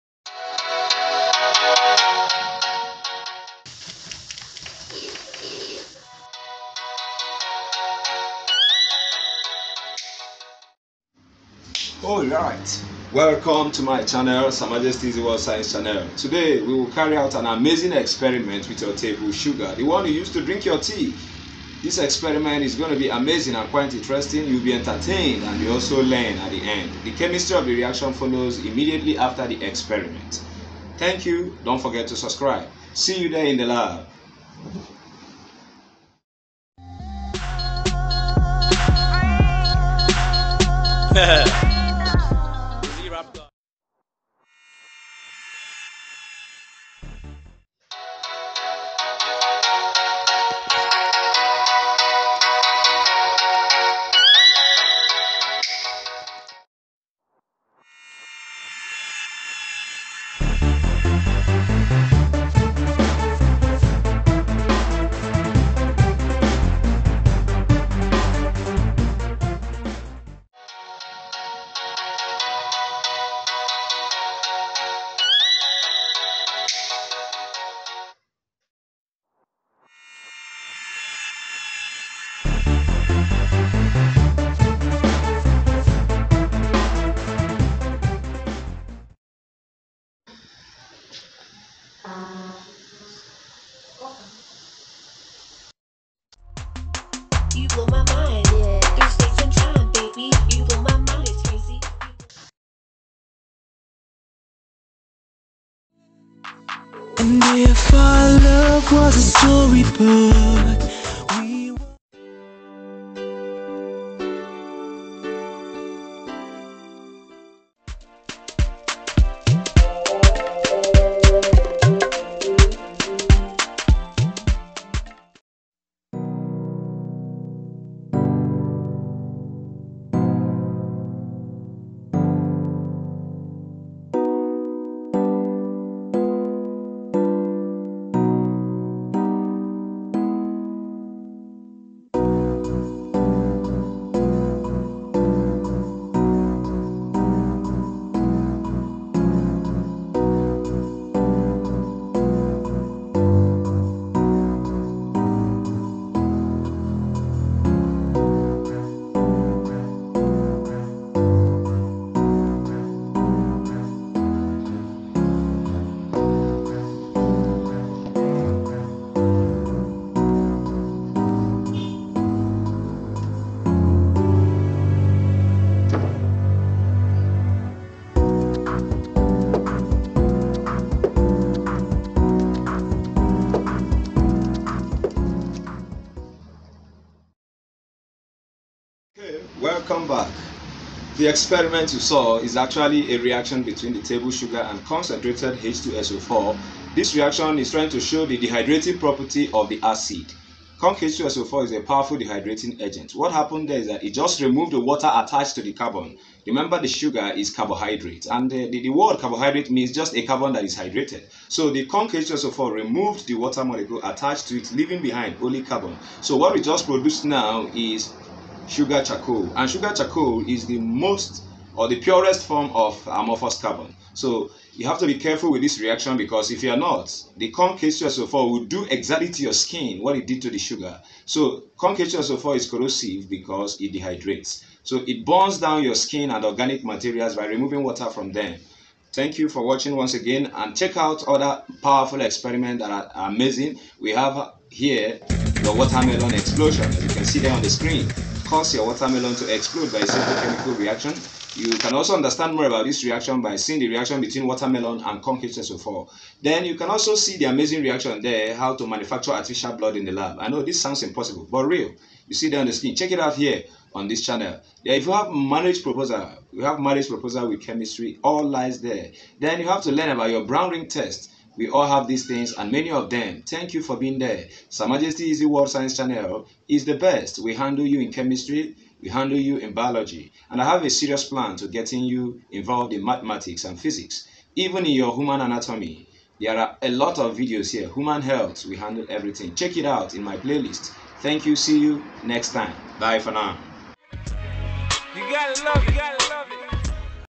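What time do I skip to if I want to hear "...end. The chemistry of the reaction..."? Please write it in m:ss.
0:26.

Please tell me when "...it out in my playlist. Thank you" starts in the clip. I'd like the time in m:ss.
4:49.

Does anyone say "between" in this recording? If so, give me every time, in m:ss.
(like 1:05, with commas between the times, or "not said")
3:13, 4:14.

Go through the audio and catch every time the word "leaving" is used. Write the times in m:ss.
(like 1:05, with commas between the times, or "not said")
3:34.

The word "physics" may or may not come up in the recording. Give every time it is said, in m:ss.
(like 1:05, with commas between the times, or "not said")
4:43.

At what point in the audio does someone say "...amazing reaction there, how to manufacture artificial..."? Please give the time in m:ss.
4:17.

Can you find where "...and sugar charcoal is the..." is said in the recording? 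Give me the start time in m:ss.
3:39.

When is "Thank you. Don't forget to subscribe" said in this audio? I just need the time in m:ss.
0:30.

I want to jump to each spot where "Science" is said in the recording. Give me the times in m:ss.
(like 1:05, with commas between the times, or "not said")
0:15, 4:35.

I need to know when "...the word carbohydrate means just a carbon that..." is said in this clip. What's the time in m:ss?
3:28.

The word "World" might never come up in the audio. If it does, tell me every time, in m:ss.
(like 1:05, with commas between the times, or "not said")
0:15, 4:35.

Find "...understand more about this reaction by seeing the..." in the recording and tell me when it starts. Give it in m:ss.
4:12.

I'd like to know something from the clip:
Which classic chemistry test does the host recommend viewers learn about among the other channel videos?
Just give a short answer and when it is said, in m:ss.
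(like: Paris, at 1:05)
brown ring test, at 4:30.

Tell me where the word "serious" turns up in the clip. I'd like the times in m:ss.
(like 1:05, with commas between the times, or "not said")
4:40.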